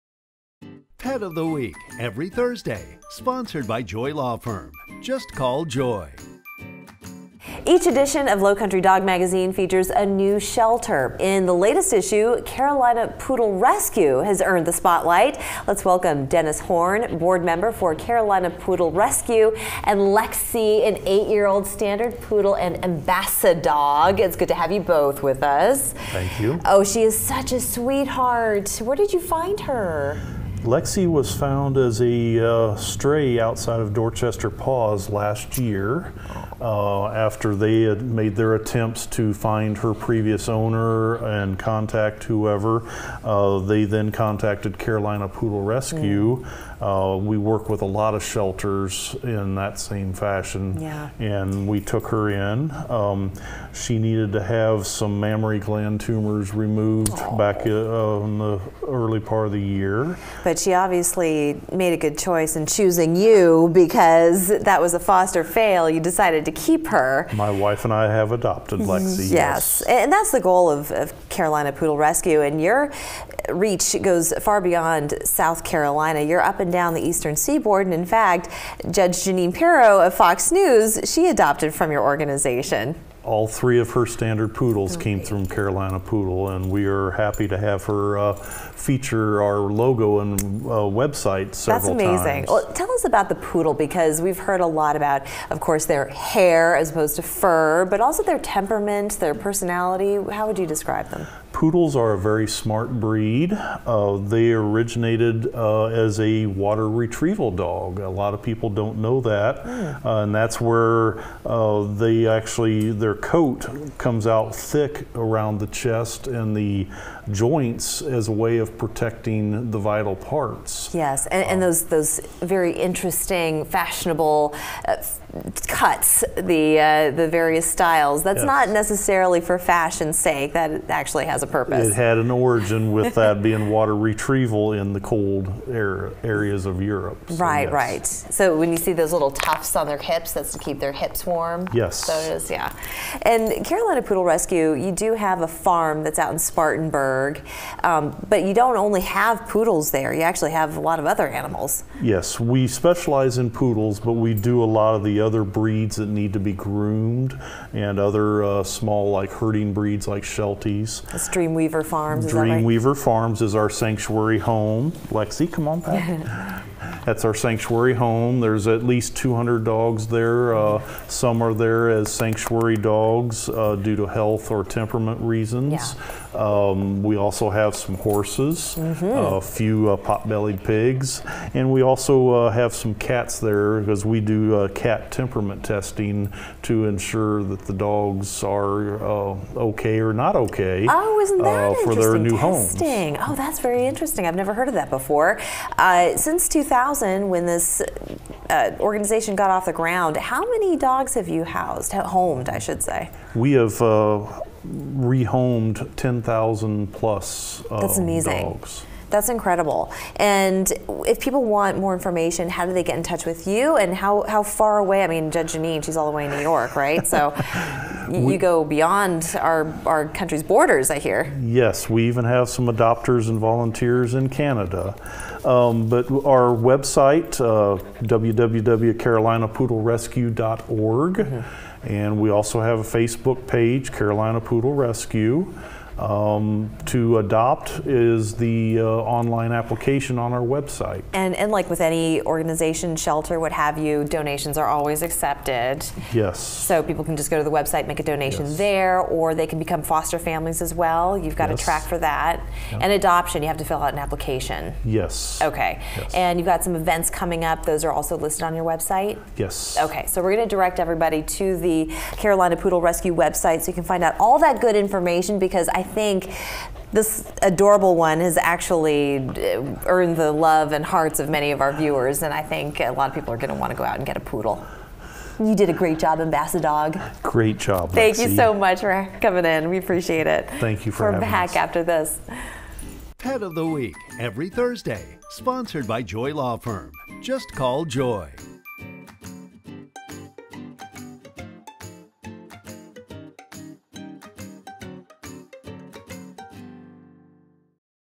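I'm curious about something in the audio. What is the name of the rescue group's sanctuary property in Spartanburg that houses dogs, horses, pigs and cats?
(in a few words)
Dreamweaver Farms.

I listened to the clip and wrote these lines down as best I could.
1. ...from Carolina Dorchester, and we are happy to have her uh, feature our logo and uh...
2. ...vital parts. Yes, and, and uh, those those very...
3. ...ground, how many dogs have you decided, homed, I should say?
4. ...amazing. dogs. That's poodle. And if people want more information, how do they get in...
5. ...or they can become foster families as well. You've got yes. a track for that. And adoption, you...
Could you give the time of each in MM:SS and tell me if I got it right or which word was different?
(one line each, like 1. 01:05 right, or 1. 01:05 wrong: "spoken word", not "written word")
1. 01:25 wrong: "Poodle", not "Dorchester"
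2. 01:59 right
3. 03:19 wrong: "housed", not "decided"
4. 03:27 wrong: "incredible", not "poodle"
5. 04:08 right.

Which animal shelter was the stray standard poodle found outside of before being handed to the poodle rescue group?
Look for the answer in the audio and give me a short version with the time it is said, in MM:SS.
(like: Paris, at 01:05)
Dorchester Paws, at 00:33.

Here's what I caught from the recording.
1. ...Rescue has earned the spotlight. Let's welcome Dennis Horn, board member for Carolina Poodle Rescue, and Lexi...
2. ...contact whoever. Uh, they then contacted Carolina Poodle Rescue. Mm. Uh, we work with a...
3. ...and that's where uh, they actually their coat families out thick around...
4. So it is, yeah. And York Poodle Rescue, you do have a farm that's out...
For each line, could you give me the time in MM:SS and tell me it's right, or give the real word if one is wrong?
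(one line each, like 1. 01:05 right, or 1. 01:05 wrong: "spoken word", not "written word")
1. 00:13 right
2. 00:41 right
3. 01:50 wrong: "comes", not "families"
4. 02:22 wrong: "Carolina", not "York".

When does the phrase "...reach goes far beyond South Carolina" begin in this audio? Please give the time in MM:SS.
01:13.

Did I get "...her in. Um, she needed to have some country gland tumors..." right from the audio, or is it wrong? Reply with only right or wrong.
wrong.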